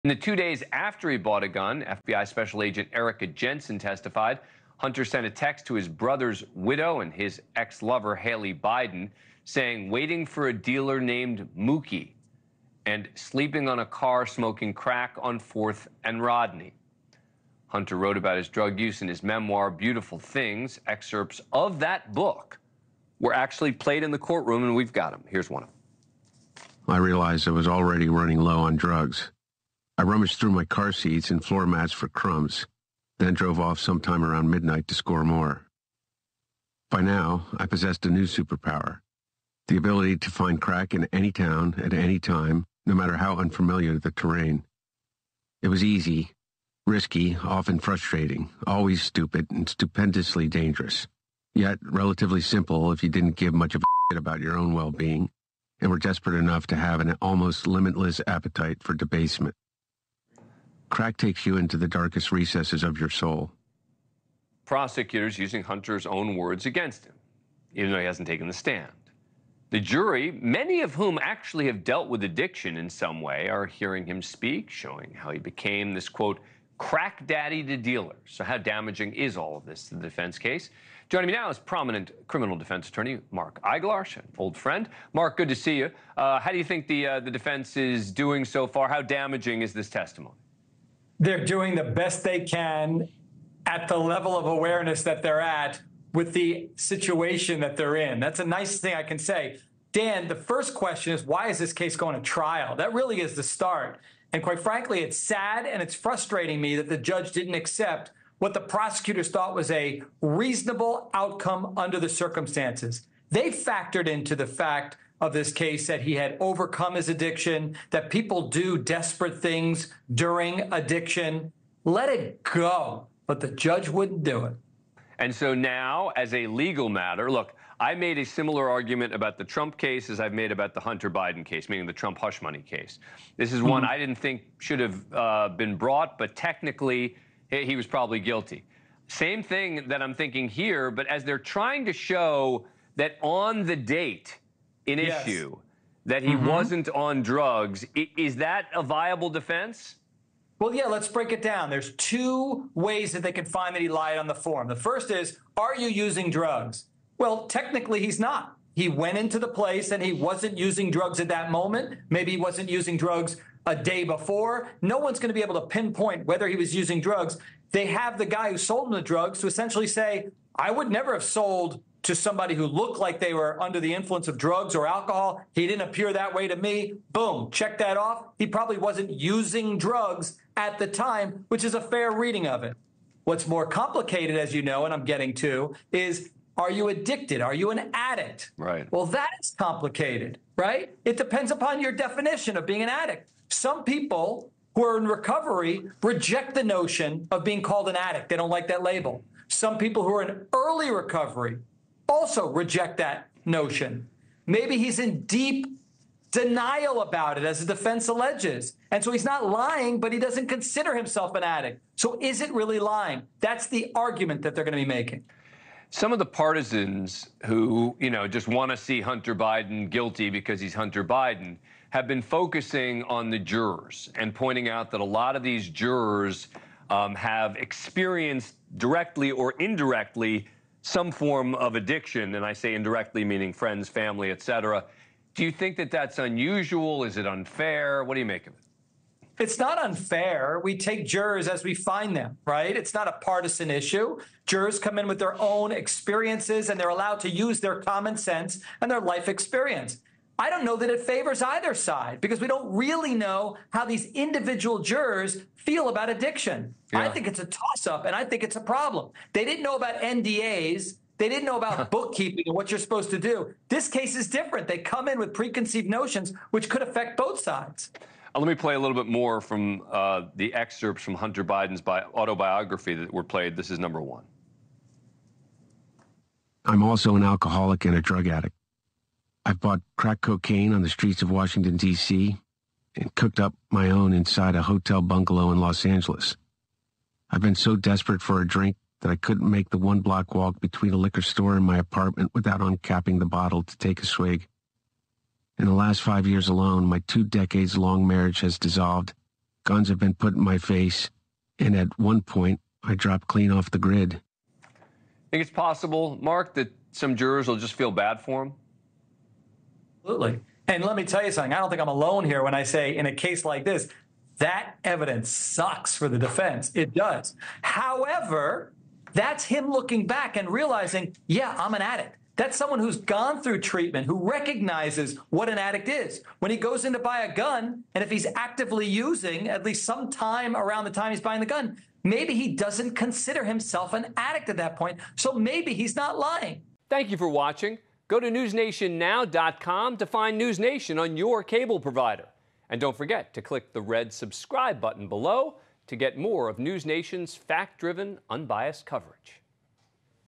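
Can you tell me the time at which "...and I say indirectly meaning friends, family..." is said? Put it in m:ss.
3:52.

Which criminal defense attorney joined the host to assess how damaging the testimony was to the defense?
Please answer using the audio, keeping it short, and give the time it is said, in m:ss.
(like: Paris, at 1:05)
Mark Eiglarsh, at 1:23.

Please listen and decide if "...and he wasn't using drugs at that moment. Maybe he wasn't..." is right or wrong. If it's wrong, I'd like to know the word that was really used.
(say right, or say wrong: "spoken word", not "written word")
right.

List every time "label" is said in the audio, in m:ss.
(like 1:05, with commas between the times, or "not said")
3:18.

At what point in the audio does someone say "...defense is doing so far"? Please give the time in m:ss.
1:27.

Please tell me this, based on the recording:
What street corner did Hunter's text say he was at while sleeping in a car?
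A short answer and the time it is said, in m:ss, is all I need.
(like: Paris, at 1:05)
4th and Rodney, at 0:15.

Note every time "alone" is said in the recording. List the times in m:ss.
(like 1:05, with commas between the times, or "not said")
4:56, 5:11.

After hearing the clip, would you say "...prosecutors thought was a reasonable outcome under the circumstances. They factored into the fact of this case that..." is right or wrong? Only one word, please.
right.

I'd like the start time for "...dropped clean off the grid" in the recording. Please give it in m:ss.
5:02.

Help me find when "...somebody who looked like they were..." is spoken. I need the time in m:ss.
2:52.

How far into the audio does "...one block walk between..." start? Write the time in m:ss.
4:49.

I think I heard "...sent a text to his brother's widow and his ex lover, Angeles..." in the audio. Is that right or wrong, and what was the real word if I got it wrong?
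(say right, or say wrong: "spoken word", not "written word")
wrong: "Hallie", not "Angeles".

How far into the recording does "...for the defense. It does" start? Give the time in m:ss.
5:15.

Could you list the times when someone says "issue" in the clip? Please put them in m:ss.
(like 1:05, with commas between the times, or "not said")
2:25, 4:03.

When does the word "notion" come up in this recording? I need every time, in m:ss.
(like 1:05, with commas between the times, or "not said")
3:16, 3:23, 4:25.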